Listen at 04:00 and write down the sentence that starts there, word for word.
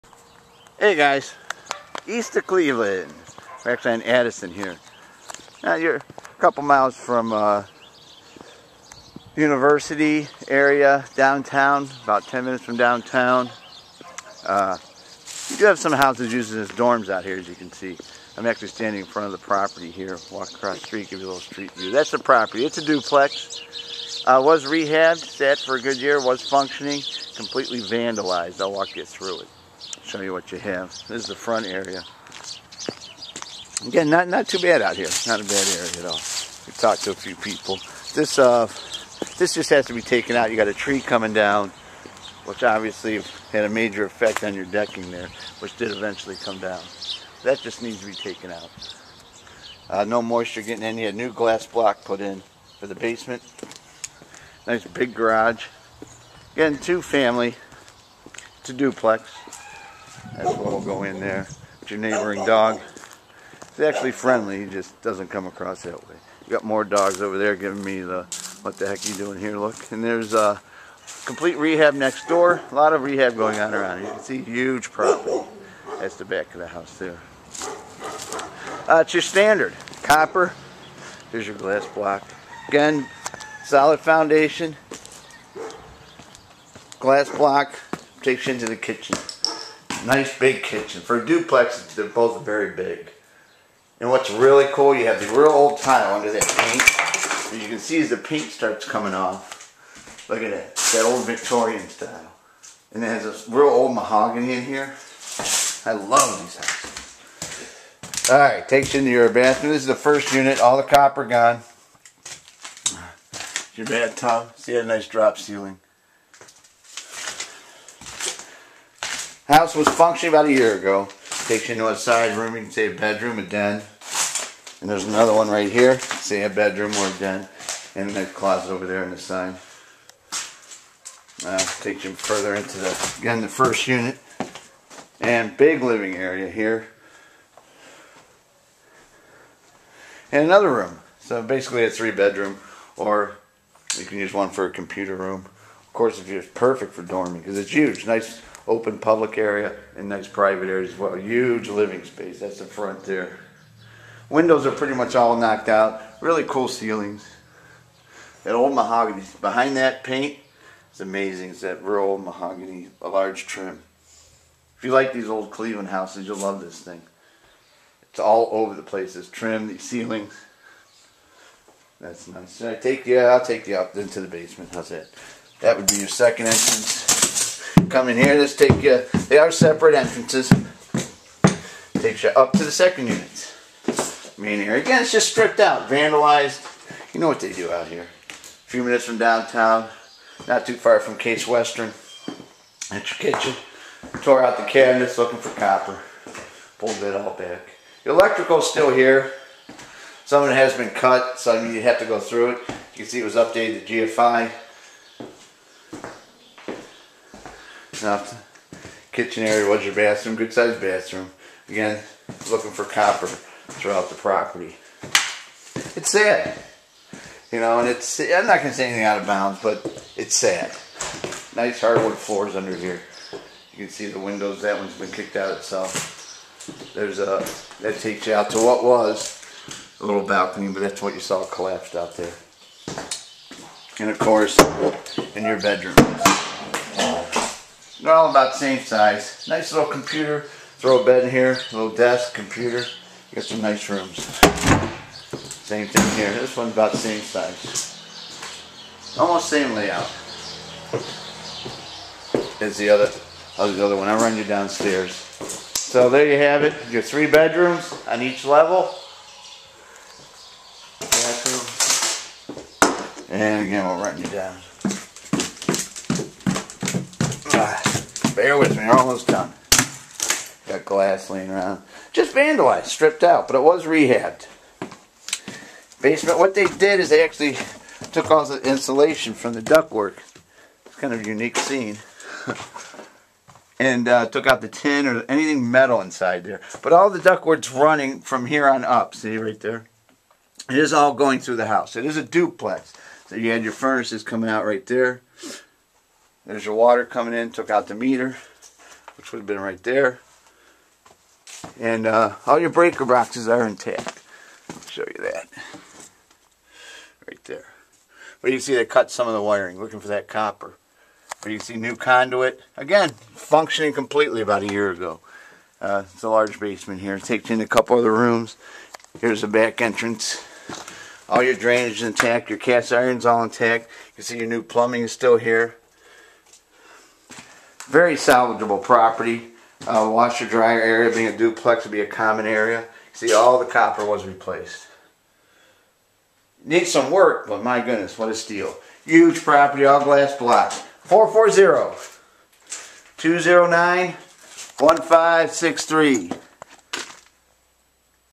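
Throw a bed in here, little desk, computer.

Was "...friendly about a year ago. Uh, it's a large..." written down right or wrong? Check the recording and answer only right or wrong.
wrong.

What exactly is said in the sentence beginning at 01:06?
You got more dogs over there giving me the what the heck you doing here look.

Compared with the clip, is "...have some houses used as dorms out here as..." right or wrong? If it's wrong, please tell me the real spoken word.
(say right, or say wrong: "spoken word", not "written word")
right.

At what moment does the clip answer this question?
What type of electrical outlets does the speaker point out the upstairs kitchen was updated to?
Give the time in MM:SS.
03:24.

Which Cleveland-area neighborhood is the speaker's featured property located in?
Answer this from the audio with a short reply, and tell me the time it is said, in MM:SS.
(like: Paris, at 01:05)
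Addison, at 00:04.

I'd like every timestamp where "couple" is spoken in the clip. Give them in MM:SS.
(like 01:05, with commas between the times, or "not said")
00:06, 05:17.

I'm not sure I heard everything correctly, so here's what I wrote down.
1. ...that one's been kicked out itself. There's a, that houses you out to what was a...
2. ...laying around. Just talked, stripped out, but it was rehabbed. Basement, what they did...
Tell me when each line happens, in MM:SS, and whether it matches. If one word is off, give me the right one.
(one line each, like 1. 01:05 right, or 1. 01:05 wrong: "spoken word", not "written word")
1. 03:44 wrong: "takes", not "houses"
2. 04:31 wrong: "vandalized", not "talked".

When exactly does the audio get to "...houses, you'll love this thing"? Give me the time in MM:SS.
02:45.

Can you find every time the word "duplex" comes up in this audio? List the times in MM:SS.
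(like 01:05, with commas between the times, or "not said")
00:22, 00:58, 01:31, 04:52, 05:31.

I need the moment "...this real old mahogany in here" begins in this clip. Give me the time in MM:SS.
01:43.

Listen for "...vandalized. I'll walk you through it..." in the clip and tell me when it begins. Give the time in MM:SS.
00:27.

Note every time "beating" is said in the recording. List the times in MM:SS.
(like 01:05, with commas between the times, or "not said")
not said.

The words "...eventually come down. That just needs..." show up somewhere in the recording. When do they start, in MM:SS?
00:45.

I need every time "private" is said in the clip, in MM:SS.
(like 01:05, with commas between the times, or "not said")
02:30.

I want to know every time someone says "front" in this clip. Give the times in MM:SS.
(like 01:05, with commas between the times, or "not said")
00:19, 00:31, 02:32.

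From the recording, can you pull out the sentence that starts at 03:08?
A few minutes from downtown, not too far from Case Western.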